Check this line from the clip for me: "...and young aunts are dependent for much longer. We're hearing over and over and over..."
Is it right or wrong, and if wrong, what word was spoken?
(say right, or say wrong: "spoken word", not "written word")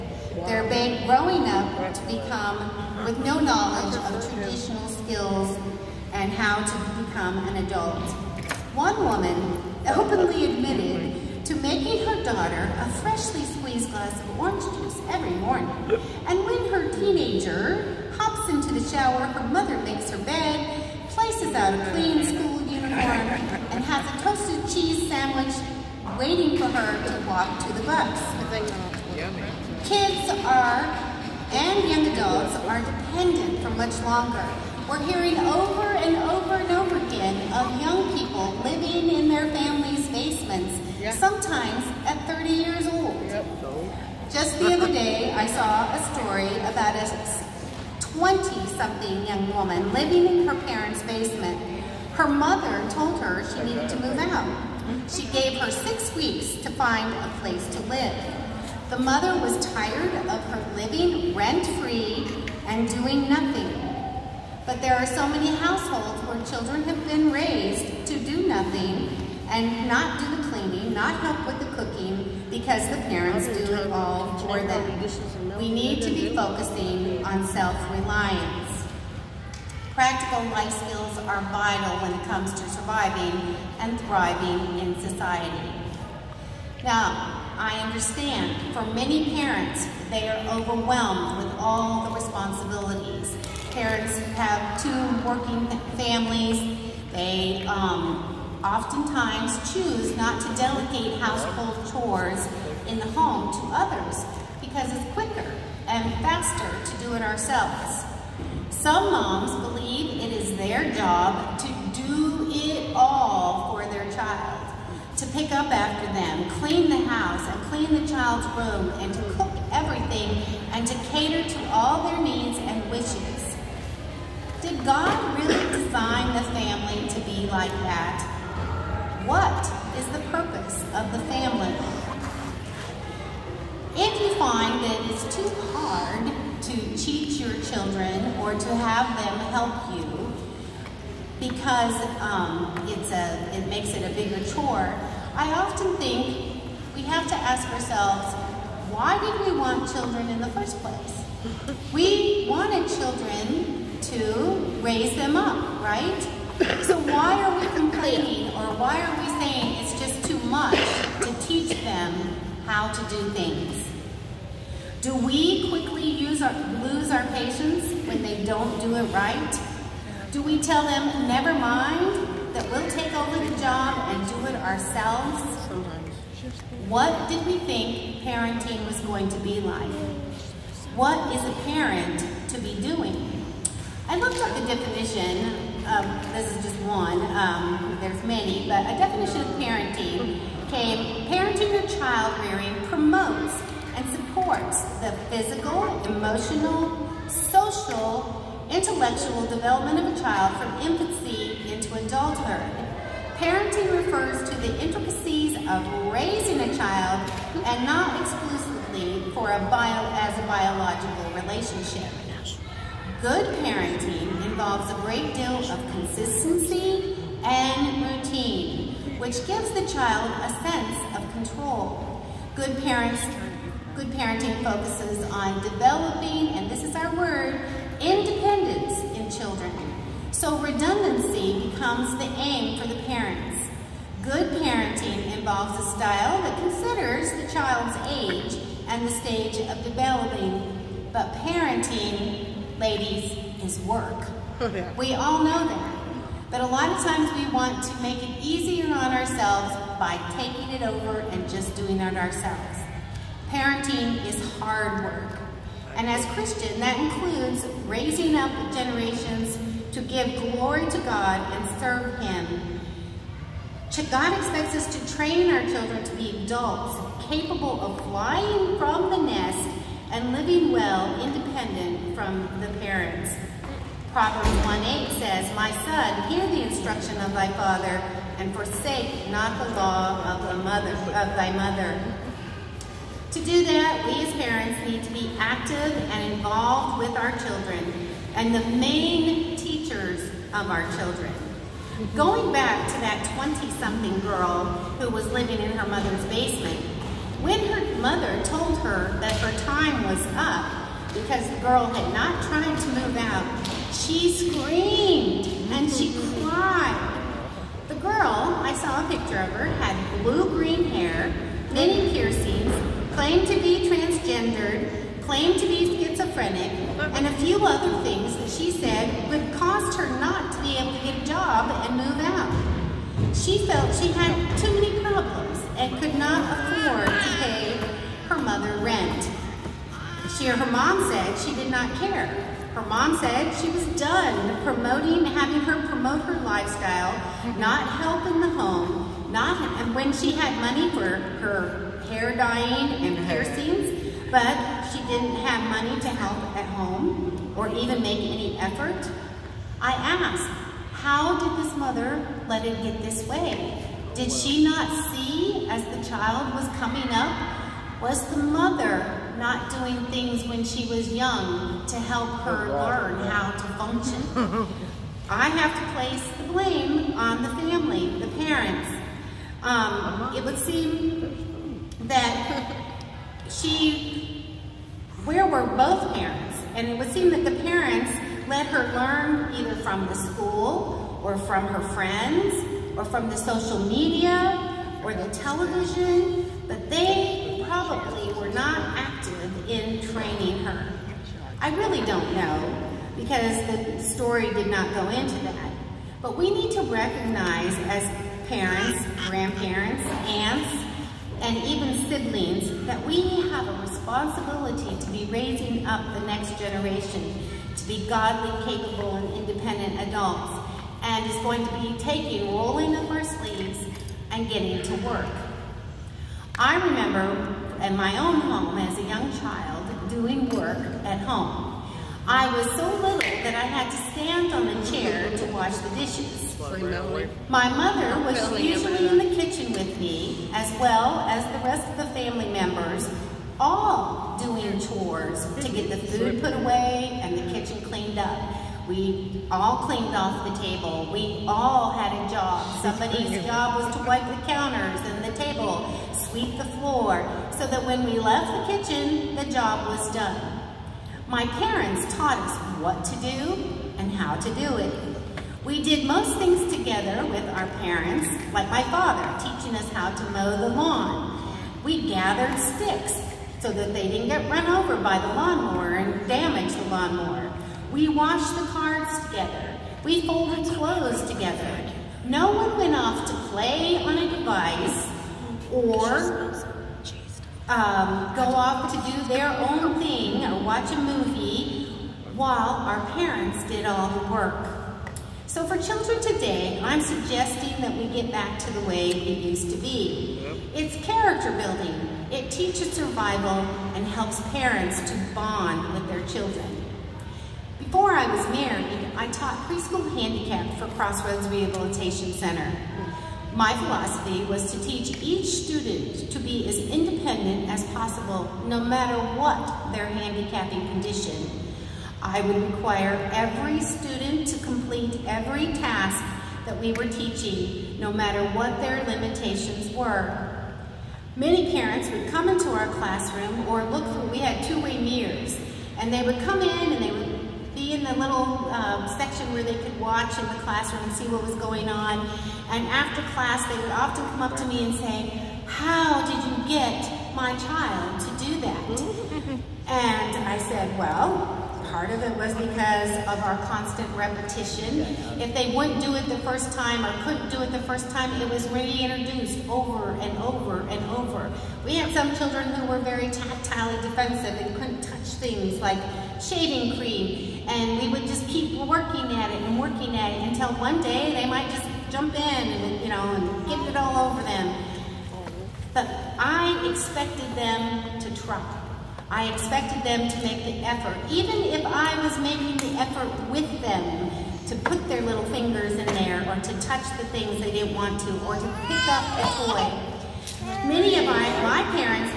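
wrong: "adults", not "aunts".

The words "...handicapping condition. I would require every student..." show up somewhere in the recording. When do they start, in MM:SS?
08:30.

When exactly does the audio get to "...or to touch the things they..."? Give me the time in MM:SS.
09:36.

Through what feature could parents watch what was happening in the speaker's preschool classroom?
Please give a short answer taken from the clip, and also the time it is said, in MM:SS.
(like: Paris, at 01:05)
two-way mirrors, at 08:44.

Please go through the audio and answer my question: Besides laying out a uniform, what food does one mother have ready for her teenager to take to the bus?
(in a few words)
toasted cheese sandwich.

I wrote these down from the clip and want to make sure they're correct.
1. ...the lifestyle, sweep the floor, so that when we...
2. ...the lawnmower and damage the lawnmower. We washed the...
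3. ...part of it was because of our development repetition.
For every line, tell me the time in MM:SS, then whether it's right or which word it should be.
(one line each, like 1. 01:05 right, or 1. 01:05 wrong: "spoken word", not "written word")
1. 07:25 wrong: "table", not "lifestyle"
2. 07:45 right
3. 09:01 wrong: "constant", not "development".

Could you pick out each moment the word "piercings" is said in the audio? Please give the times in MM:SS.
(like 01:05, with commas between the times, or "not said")
05:12, 05:43.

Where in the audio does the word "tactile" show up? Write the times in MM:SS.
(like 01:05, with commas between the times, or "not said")
09:13.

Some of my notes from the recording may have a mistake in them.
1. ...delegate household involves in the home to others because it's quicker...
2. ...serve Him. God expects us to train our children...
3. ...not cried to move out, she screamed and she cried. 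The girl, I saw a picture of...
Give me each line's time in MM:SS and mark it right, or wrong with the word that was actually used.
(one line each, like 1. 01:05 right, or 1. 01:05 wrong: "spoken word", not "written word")
1. 01:40 wrong: "chores", not "involves"
2. 04:21 right
3. 05:02 wrong: "tried", not "cried".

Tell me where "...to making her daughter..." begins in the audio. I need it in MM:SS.
00:11.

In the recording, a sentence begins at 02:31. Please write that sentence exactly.
We wanted children to raise them up, right?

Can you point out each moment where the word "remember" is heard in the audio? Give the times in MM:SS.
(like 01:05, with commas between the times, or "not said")
06:56.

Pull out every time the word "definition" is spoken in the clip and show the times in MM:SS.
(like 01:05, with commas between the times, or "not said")
03:04, 03:08.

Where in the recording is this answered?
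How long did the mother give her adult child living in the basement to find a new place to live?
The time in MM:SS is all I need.
00:55.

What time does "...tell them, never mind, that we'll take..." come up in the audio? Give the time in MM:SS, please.
02:50.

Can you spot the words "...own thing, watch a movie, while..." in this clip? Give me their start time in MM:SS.
07:59.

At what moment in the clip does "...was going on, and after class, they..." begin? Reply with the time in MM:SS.
08:51.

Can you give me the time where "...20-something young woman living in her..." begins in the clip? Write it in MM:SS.
00:48.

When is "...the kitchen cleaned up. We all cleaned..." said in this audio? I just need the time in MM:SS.
07:17.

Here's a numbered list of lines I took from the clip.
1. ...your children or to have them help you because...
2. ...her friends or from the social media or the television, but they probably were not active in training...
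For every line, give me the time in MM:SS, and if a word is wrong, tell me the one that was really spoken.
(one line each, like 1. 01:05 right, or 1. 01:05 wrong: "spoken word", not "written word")
1. 02:17 right
2. 06:21 right.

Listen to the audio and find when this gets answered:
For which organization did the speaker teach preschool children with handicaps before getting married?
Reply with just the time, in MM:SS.
08:20.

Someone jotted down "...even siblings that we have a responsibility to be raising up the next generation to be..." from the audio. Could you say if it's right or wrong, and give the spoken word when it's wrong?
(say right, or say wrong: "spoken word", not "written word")
right.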